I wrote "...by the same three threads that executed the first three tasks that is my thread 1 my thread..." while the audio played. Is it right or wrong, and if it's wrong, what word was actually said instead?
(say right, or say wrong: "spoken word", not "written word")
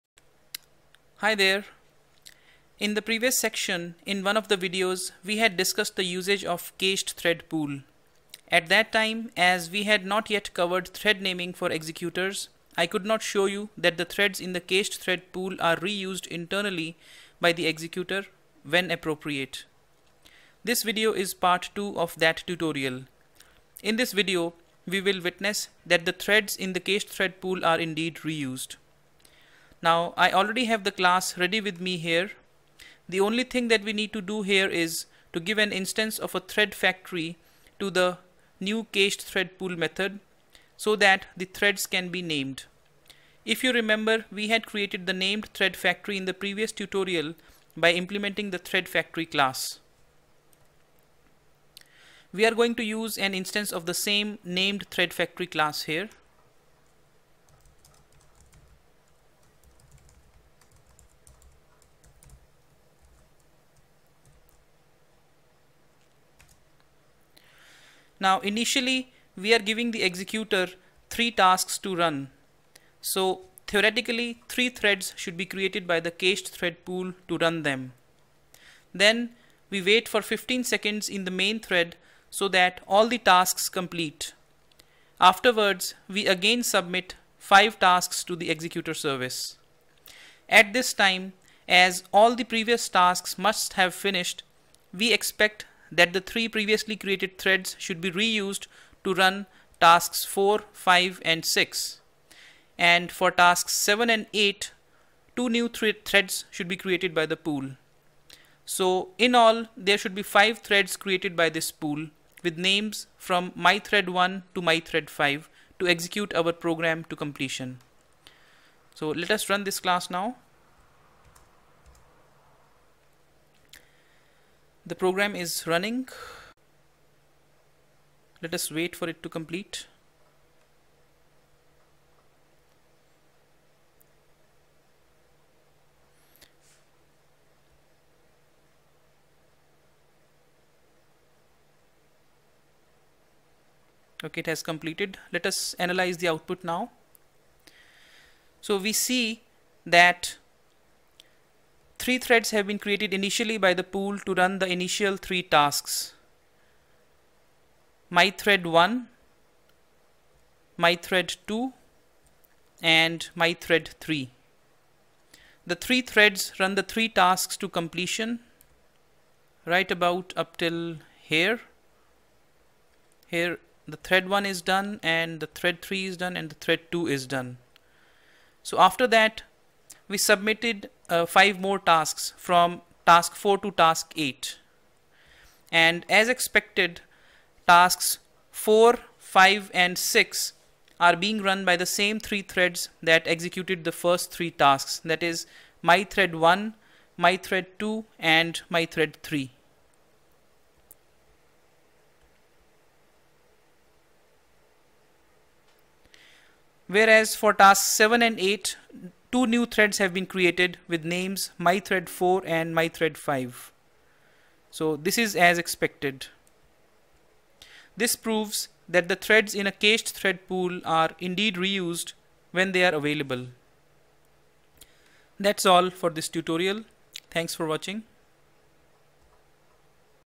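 right.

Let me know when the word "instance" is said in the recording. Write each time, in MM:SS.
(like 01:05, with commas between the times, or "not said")
00:35, 00:53.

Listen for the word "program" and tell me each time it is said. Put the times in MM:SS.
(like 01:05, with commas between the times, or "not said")
01:56, 02:05.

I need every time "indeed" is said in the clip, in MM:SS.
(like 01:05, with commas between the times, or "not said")
00:27, 03:41.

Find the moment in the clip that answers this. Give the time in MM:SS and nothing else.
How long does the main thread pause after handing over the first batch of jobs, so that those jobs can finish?
01:20.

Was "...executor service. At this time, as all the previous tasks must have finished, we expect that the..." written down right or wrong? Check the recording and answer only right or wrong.
right.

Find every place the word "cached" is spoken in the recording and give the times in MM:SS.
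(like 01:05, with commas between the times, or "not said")
00:06, 00:14, 00:26, 00:38, 01:16, 03:39.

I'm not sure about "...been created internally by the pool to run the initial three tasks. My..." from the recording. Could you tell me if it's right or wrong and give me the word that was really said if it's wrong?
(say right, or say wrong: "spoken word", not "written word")
wrong: "initially", not "internally".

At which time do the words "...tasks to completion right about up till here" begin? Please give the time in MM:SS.
02:47.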